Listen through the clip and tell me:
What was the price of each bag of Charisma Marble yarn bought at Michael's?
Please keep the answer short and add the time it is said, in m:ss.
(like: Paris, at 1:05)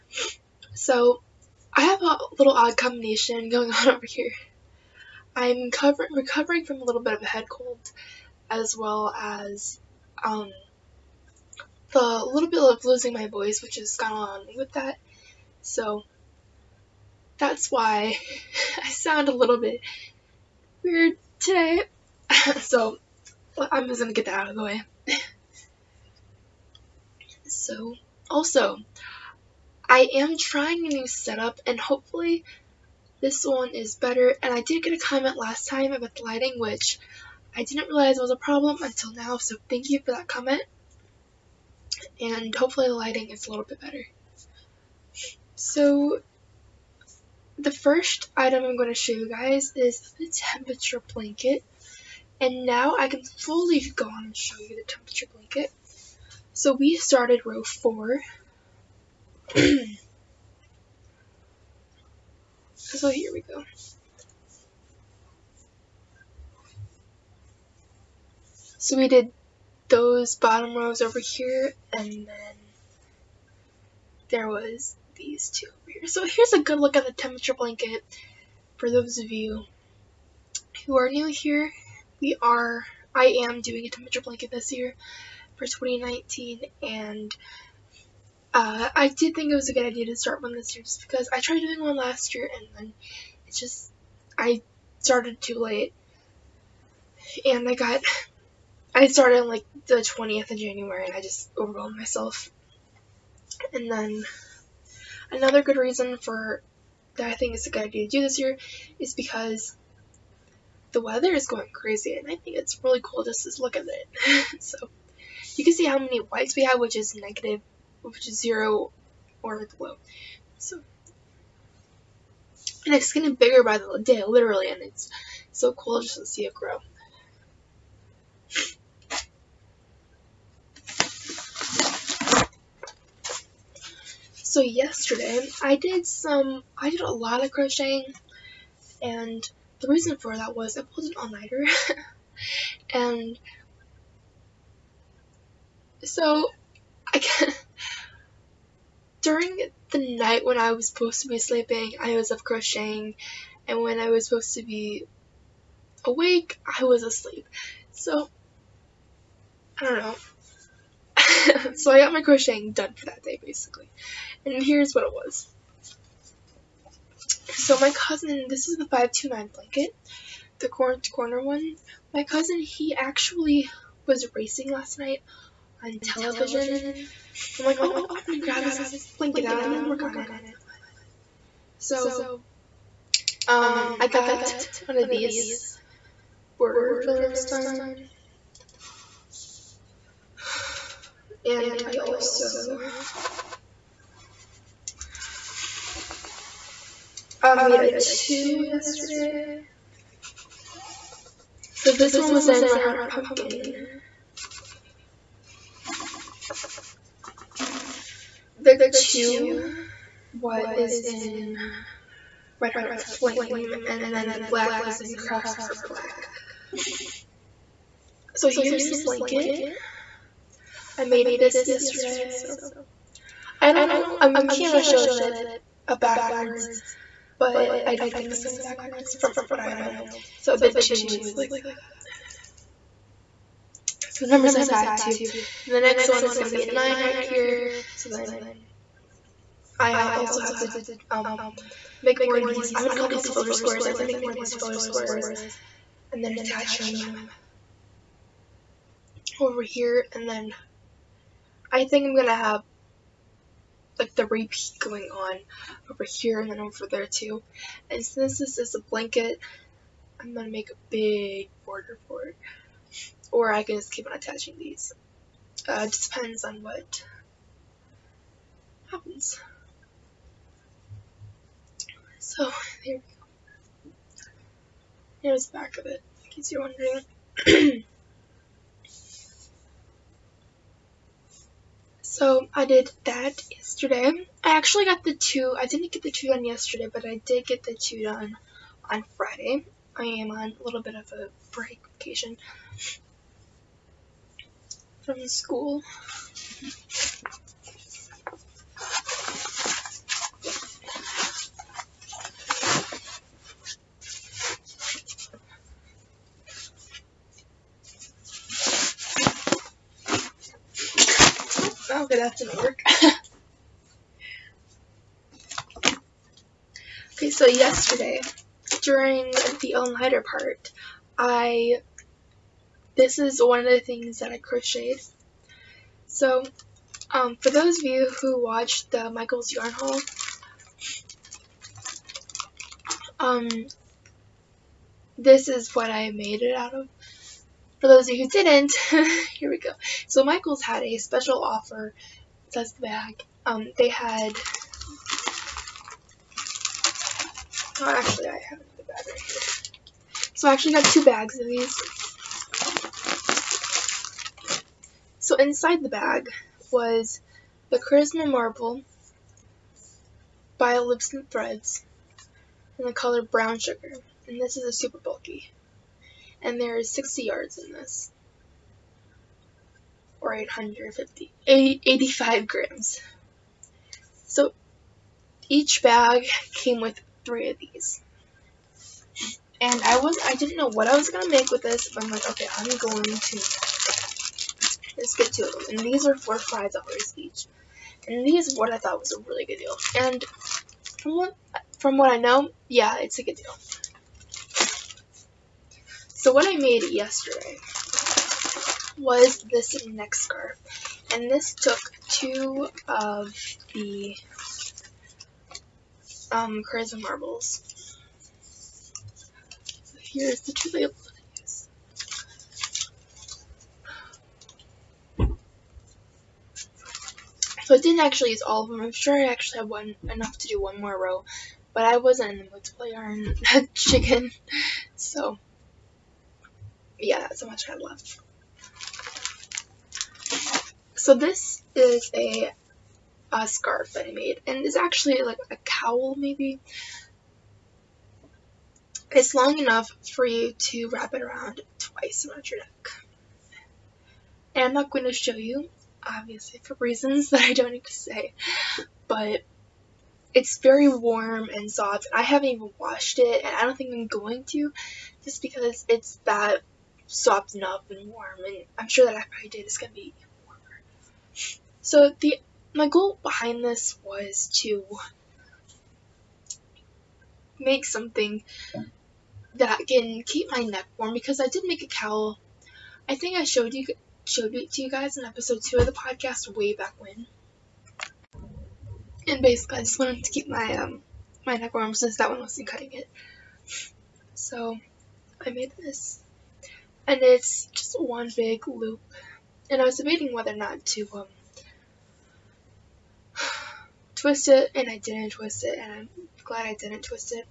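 $5, at 6:26.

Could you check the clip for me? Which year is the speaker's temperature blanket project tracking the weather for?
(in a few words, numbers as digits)
2019.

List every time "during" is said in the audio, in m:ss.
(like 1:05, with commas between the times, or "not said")
2:29, 5:18.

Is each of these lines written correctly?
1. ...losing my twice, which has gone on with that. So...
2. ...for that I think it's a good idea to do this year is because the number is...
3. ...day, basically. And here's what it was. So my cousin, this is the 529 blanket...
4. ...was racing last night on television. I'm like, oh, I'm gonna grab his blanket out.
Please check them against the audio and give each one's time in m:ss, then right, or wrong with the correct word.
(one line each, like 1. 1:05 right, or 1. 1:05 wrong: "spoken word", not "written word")
1. 0:12 wrong: "voice", not "twice"
2. 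1:46 wrong: "weather", not "number"
3. 2:43 right
4. 2:54 right.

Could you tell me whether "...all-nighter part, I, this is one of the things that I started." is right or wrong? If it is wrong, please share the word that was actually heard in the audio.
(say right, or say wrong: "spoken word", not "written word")
wrong: "crocheted", not "started".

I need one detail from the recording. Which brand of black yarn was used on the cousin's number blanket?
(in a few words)
Craftsmart.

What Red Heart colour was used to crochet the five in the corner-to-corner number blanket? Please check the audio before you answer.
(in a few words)
Pumpkin.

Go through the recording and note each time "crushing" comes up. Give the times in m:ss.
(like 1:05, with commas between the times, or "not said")
not said.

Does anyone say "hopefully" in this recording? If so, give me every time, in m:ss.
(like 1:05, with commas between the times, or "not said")
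0:31, 0:42.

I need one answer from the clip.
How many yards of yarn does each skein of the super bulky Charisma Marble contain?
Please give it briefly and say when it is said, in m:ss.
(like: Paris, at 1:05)
60 yards, at 6:06.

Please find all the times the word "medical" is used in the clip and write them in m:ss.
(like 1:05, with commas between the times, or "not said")
not said.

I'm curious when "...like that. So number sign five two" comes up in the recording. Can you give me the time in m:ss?
3:51.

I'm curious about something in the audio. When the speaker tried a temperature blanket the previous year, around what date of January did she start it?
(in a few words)
the 20th.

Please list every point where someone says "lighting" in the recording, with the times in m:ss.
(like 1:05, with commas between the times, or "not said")
0:36, 0:42.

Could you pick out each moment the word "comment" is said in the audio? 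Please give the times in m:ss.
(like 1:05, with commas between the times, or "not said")
0:34, 0:40.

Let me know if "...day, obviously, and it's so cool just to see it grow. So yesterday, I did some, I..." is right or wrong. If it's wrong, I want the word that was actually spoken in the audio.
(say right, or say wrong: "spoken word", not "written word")
wrong: "literally", not "obviously".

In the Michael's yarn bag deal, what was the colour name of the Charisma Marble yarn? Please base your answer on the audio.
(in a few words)
Brown Sugar.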